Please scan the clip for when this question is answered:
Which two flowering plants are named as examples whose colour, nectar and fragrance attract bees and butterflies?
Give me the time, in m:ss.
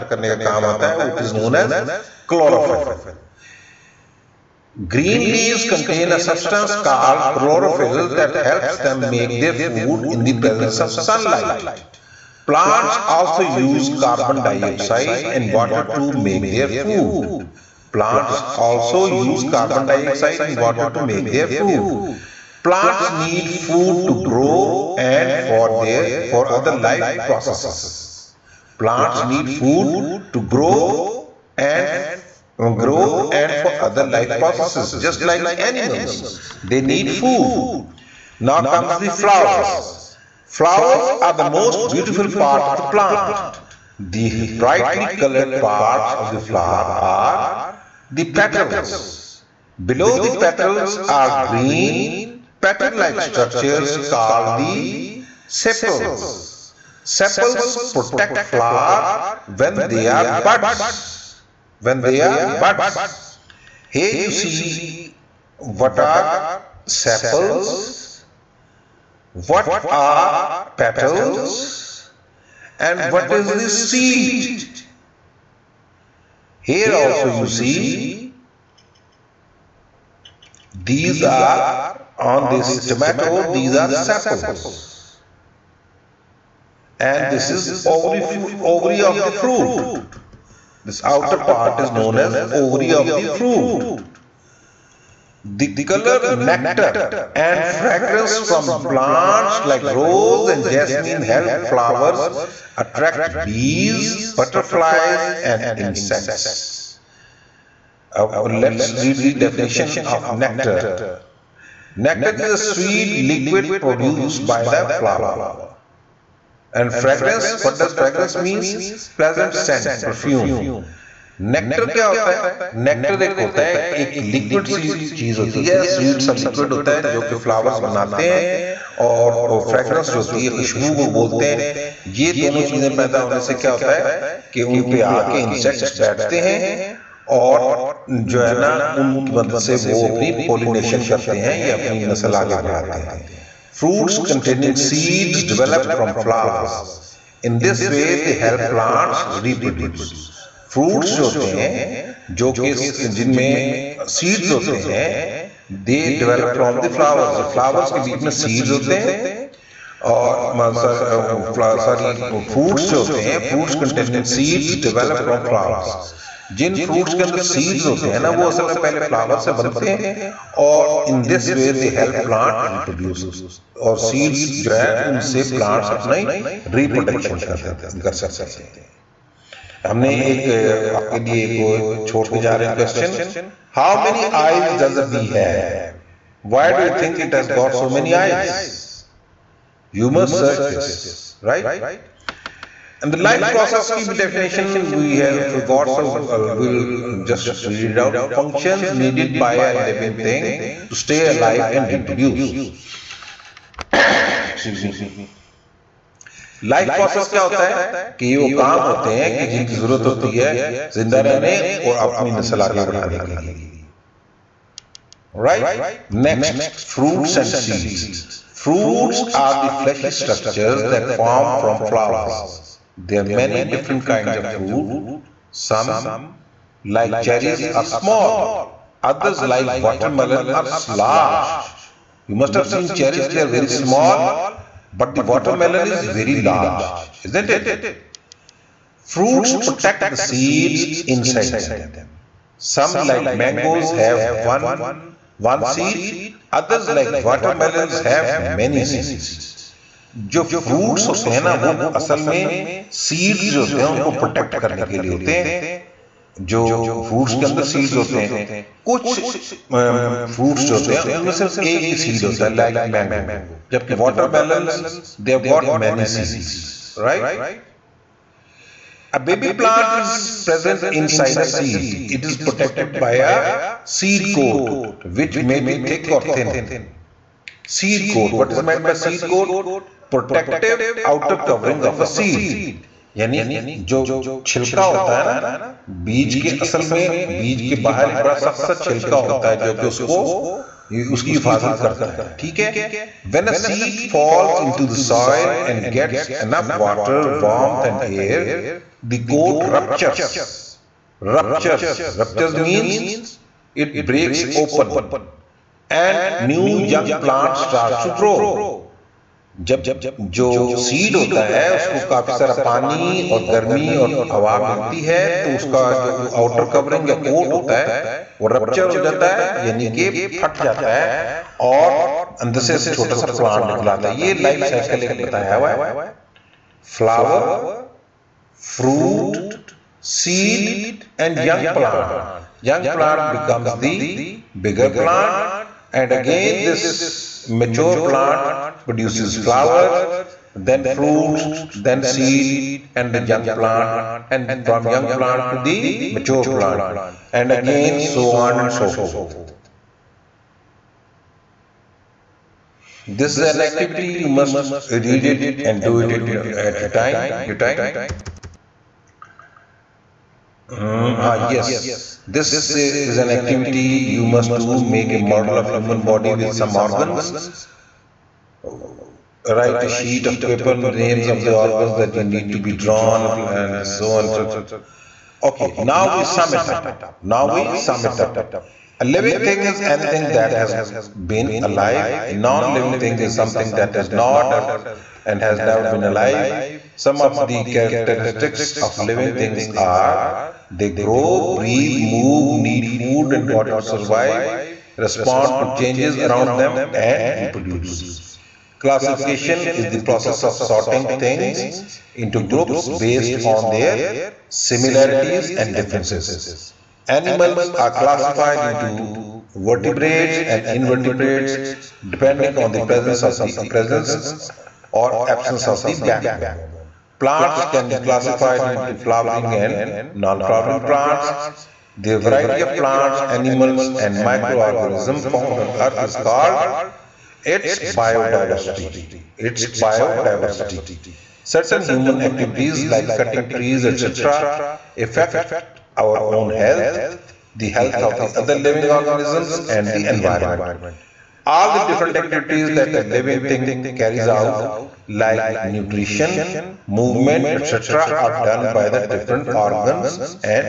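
1:39.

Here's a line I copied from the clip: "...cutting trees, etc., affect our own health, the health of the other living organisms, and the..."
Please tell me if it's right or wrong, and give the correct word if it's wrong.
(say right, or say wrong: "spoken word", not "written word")
right.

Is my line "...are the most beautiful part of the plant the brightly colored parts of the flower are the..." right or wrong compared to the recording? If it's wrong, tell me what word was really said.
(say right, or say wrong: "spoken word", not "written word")
right.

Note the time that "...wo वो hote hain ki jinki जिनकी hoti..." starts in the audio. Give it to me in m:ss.
3:28.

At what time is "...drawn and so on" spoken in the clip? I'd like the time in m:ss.
6:12.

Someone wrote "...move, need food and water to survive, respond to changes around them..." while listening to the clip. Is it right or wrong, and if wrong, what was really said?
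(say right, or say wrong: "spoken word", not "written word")
right.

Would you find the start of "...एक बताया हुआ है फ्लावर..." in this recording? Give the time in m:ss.
5:25.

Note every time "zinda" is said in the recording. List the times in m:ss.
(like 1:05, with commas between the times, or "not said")
3:30.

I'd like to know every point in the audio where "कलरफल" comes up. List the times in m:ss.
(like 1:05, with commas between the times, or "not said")
0:02, 0:07.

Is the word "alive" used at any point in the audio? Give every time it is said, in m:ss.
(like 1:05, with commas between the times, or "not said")
3:21, 6:21, 6:26.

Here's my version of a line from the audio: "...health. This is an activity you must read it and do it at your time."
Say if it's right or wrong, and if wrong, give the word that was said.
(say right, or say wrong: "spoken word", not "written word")
wrong: "forth", not "health".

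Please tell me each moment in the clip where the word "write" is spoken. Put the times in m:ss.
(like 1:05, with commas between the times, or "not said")
6:09.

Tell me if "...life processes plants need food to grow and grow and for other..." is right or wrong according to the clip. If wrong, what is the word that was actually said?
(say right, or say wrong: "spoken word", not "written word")
right.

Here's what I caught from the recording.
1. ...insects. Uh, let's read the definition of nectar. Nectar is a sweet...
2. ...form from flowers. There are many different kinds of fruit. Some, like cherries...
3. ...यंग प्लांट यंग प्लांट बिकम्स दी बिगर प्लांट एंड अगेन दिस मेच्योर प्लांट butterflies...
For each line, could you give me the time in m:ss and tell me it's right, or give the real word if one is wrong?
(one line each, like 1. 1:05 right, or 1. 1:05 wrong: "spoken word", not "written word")
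1. 1:45 right
2. 3:41 right
3. 5:31 wrong: "produces", not "butterflies".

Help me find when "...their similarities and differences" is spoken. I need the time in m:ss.
6:43.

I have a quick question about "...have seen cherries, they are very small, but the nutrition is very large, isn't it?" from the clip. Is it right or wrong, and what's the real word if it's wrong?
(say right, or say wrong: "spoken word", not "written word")
wrong: "watermelon", not "nutrition".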